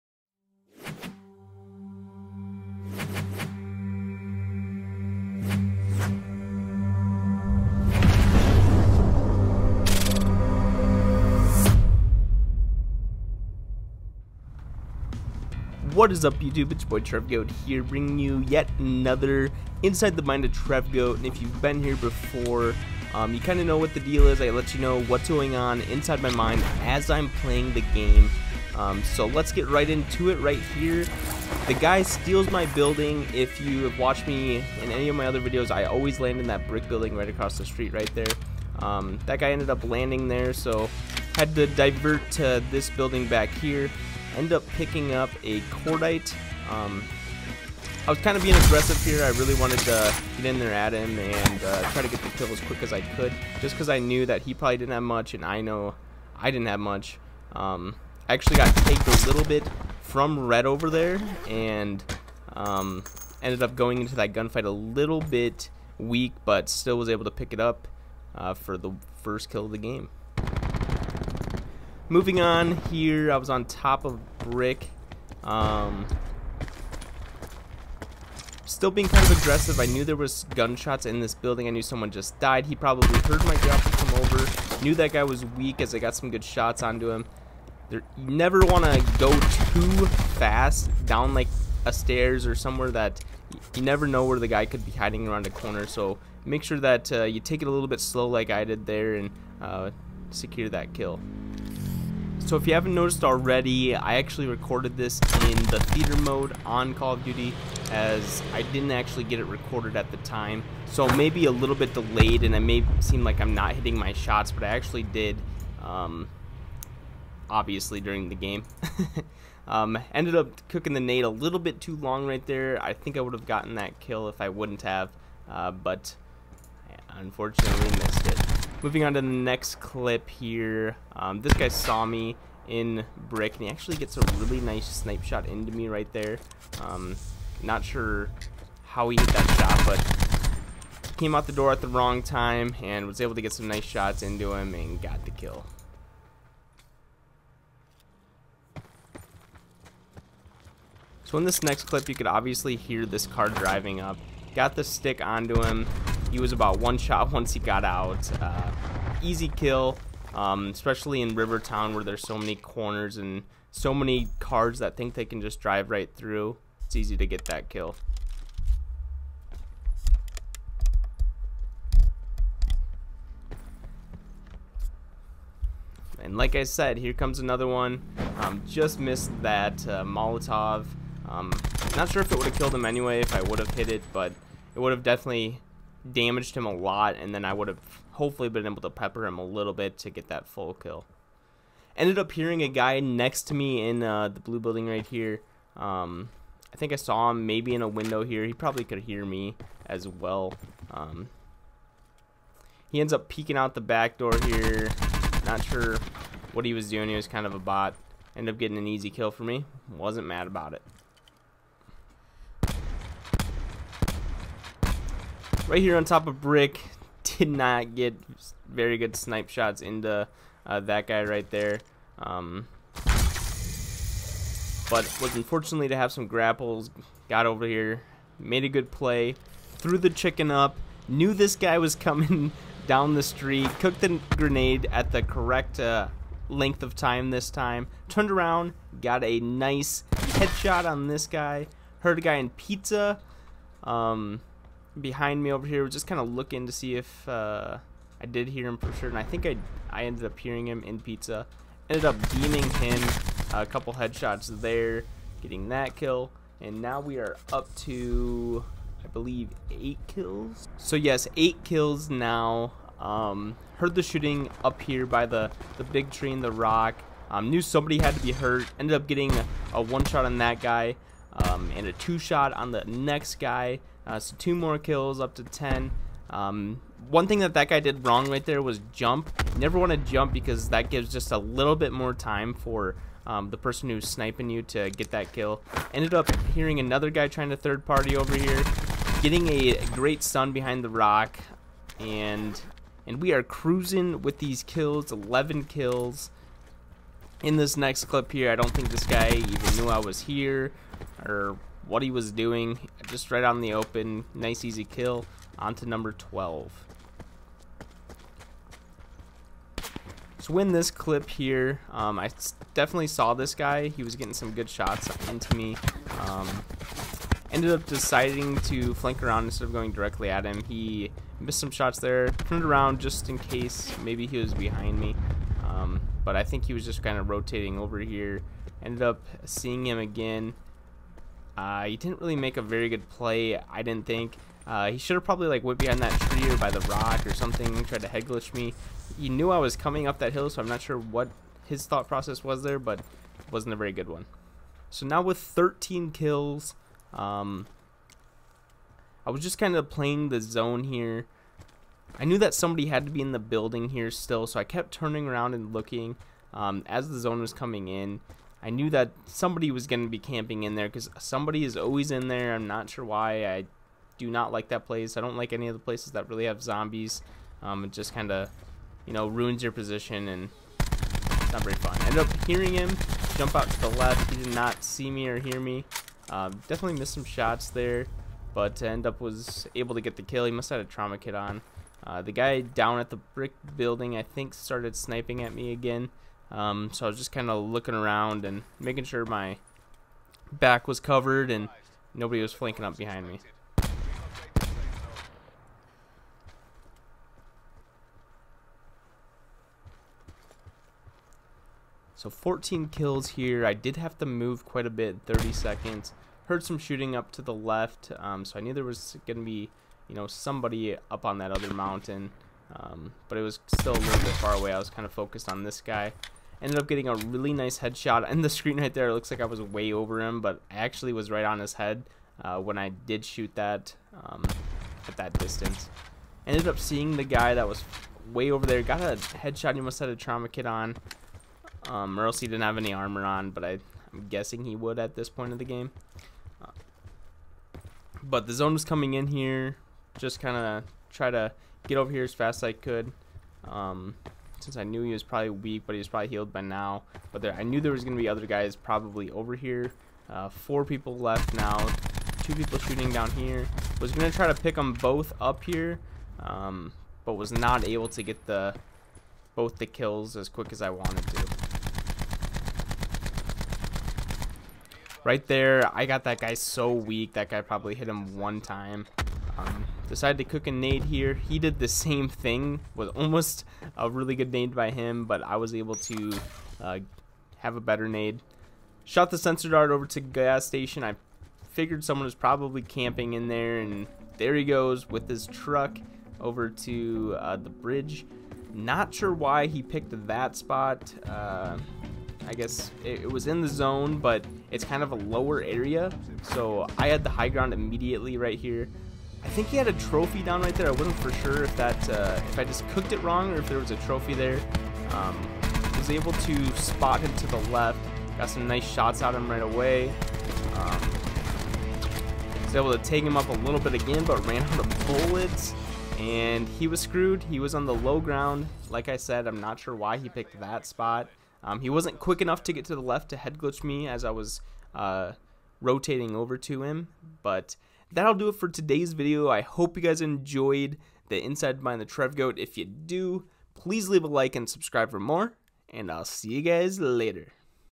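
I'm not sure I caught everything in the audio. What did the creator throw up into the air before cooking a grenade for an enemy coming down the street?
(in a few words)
the chicken.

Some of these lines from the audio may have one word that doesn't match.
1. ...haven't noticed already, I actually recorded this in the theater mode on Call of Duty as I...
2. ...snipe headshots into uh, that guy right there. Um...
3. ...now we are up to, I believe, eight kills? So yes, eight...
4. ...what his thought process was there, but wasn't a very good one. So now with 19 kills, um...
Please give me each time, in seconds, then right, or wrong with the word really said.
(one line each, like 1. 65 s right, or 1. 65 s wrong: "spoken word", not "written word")
1. 102 s right
2. 219 s wrong: "shots", not "headshots"
3. 256 s right
4. 340 s wrong: "13", not "19".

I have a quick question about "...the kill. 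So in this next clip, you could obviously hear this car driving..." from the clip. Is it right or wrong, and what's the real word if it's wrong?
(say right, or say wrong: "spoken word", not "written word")
right.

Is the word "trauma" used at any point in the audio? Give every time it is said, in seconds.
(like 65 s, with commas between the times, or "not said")
380 s, 430 s.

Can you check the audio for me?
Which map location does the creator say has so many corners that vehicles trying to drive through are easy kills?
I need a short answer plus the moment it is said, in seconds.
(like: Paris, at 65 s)
Rivertown, at 161 s.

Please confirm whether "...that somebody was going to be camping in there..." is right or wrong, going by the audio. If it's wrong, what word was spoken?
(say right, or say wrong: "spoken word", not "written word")
right.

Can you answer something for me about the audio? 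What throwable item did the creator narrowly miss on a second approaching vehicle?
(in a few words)
Molotov.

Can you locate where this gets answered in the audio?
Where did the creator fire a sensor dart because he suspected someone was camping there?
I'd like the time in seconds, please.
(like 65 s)
480 s.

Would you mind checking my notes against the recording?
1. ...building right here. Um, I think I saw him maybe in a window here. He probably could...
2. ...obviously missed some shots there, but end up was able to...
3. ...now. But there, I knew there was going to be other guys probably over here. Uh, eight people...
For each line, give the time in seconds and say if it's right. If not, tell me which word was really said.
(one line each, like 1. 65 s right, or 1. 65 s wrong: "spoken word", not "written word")
1. 194 s right
2. 376 s wrong: "definitely", not "obviously"
3. 446 s wrong: "four", not "eight".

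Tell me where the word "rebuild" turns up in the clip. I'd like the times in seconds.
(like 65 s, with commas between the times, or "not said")
not said.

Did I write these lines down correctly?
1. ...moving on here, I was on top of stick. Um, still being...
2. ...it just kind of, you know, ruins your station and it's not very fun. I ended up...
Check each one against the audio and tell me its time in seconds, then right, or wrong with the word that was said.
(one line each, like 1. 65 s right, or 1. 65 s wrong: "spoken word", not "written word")
1. 72 s wrong: "brick", not "stick"
2. 367 s wrong: "position", not "station".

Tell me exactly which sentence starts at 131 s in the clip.
Um, this guy saw me in brick and he actually gets a really nice snipe shot into me right there.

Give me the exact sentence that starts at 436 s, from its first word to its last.
Uh, but the zone was coming in here.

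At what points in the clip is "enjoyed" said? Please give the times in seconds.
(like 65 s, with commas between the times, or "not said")
530 s.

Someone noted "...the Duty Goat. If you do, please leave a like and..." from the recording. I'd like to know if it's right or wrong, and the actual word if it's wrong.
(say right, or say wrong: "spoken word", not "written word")
wrong: "Trev", not "Duty".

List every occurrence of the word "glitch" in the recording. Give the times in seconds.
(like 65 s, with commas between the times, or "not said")
338 s, 523 s.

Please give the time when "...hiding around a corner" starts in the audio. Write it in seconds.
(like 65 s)
94 s.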